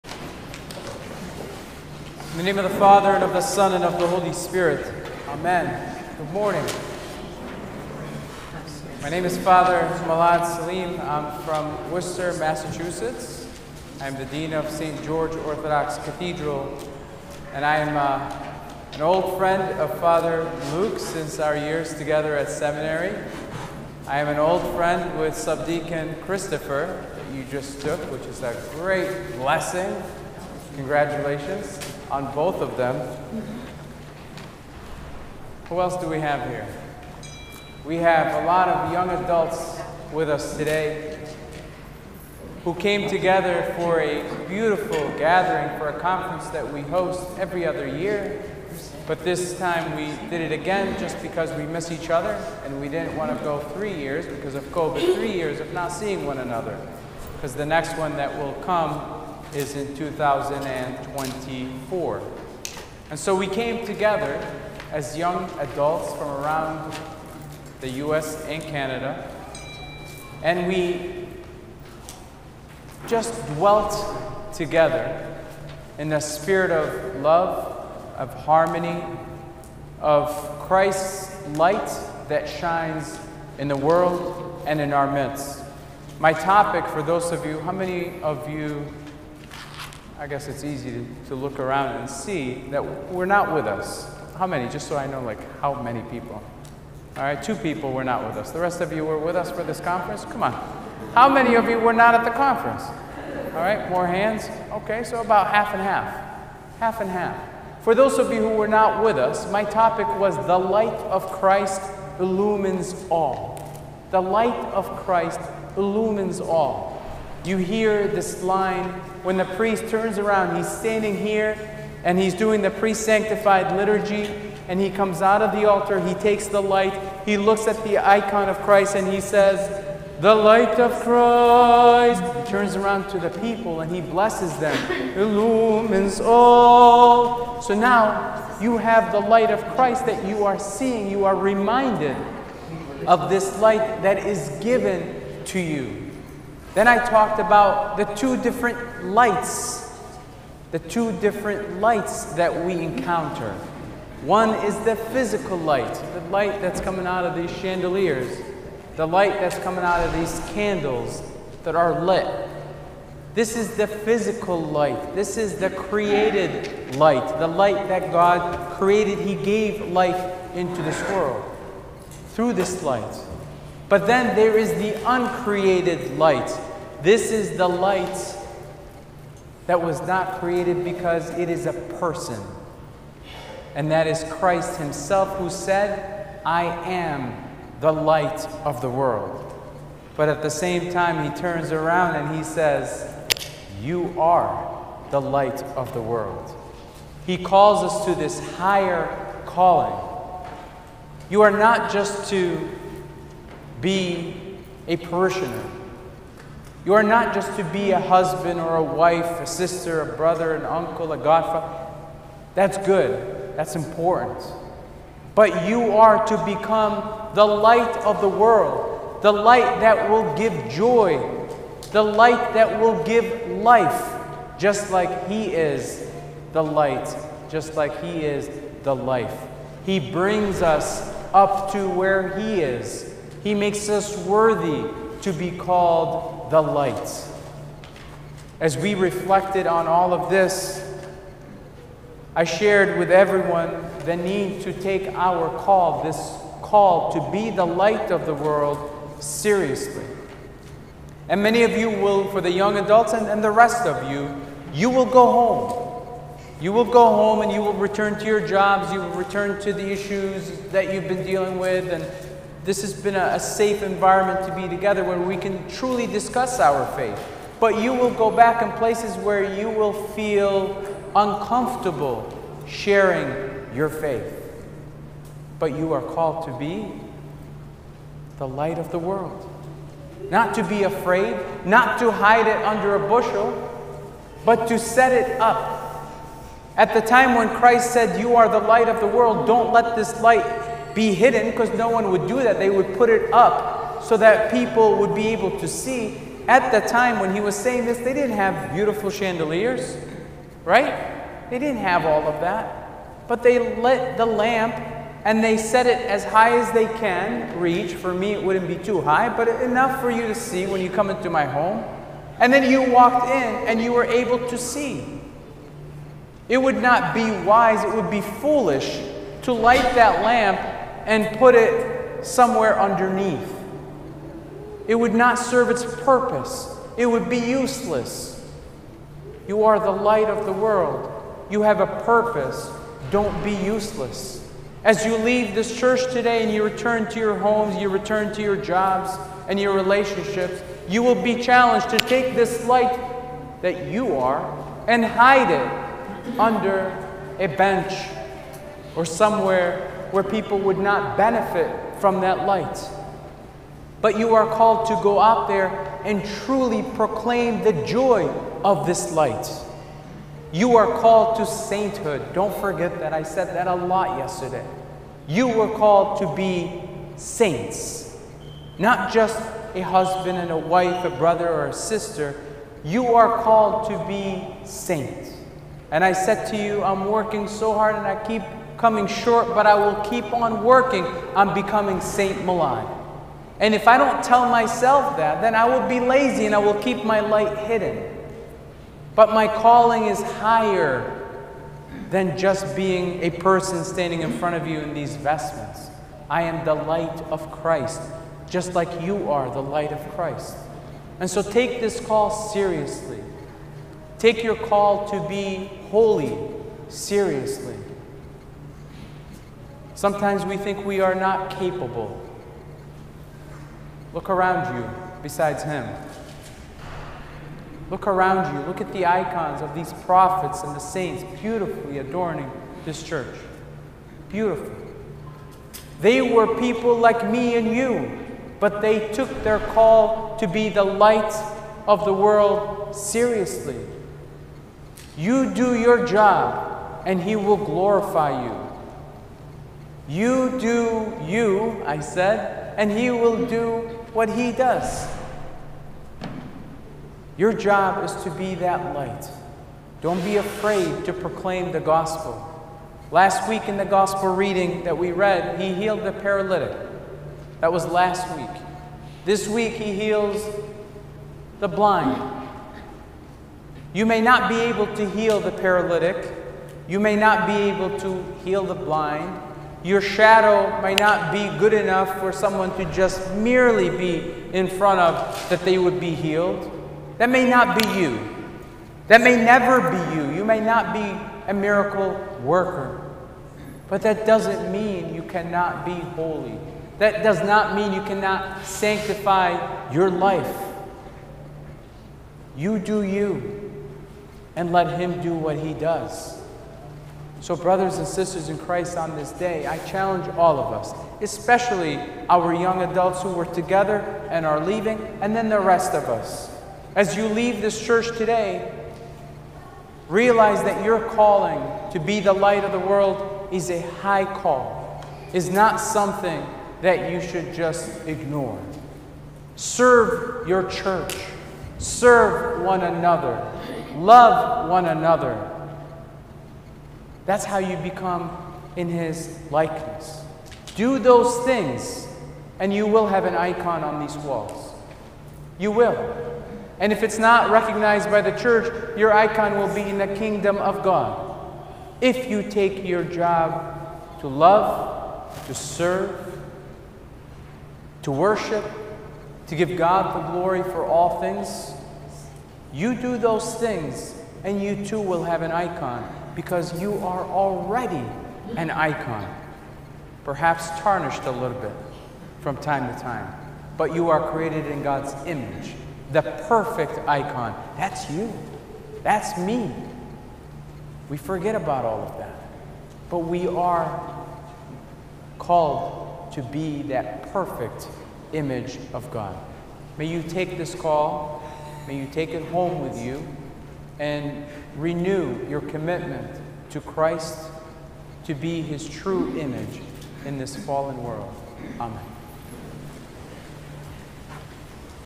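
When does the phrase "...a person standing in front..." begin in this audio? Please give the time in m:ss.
6:33.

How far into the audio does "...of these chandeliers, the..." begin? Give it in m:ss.
2:37.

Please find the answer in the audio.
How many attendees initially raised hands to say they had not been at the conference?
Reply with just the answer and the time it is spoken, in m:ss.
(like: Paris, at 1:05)
2, at 1:37.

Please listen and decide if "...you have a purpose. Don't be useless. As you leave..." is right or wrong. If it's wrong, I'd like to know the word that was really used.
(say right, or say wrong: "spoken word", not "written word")
right.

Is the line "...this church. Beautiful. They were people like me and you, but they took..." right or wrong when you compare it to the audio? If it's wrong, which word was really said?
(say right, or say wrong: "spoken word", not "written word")
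right.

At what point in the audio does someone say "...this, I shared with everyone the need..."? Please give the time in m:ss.
4:00.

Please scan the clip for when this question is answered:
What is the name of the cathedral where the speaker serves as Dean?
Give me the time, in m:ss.
0:14.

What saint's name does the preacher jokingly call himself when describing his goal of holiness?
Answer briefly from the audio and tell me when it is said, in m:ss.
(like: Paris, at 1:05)
Saint Milad, at 6:22.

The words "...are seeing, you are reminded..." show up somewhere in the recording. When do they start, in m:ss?
2:20.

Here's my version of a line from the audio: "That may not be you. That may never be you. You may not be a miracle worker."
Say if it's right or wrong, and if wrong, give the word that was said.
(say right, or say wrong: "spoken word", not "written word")
right.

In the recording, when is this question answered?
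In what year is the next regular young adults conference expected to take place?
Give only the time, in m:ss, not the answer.
0:59.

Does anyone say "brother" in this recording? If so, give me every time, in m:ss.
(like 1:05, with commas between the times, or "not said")
3:30, 6:11, 8:17.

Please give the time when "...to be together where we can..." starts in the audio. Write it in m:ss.
4:24.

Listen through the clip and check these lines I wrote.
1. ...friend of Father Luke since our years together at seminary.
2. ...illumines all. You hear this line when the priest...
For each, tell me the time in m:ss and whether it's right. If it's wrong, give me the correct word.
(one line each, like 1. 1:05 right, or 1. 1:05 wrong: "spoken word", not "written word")
1. 0:19 right
2. 1:55 right.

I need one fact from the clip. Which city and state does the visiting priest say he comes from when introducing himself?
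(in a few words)
Worcester, Massachusetts.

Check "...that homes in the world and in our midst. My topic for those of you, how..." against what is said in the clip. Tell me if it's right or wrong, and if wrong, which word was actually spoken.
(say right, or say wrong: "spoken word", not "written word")
wrong: "shines", not "homes".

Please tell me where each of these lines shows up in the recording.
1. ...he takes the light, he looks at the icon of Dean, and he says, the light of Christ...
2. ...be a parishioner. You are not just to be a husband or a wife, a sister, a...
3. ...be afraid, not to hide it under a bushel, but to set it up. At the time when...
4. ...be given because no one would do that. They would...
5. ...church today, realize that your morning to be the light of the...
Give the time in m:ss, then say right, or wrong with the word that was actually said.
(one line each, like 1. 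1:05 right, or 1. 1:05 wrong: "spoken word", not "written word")
1. 2:06 wrong: "Christ", not "Dean"
2. 3:23 right
3. 4:40 right
4. 4:50 wrong: "hidden", not "given"
5. 8:27 wrong: "calling", not "morning".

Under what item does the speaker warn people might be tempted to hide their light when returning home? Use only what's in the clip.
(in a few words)
A bench.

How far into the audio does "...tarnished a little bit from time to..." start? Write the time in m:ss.
9:20.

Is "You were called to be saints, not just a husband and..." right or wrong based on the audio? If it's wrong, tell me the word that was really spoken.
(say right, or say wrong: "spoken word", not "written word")
right.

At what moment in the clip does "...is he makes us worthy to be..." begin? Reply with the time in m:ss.
3:52.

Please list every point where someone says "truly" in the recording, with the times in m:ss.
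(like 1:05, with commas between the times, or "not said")
4:25, 5:56.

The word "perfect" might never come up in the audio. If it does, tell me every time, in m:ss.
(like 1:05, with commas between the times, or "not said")
9:26, 9:37.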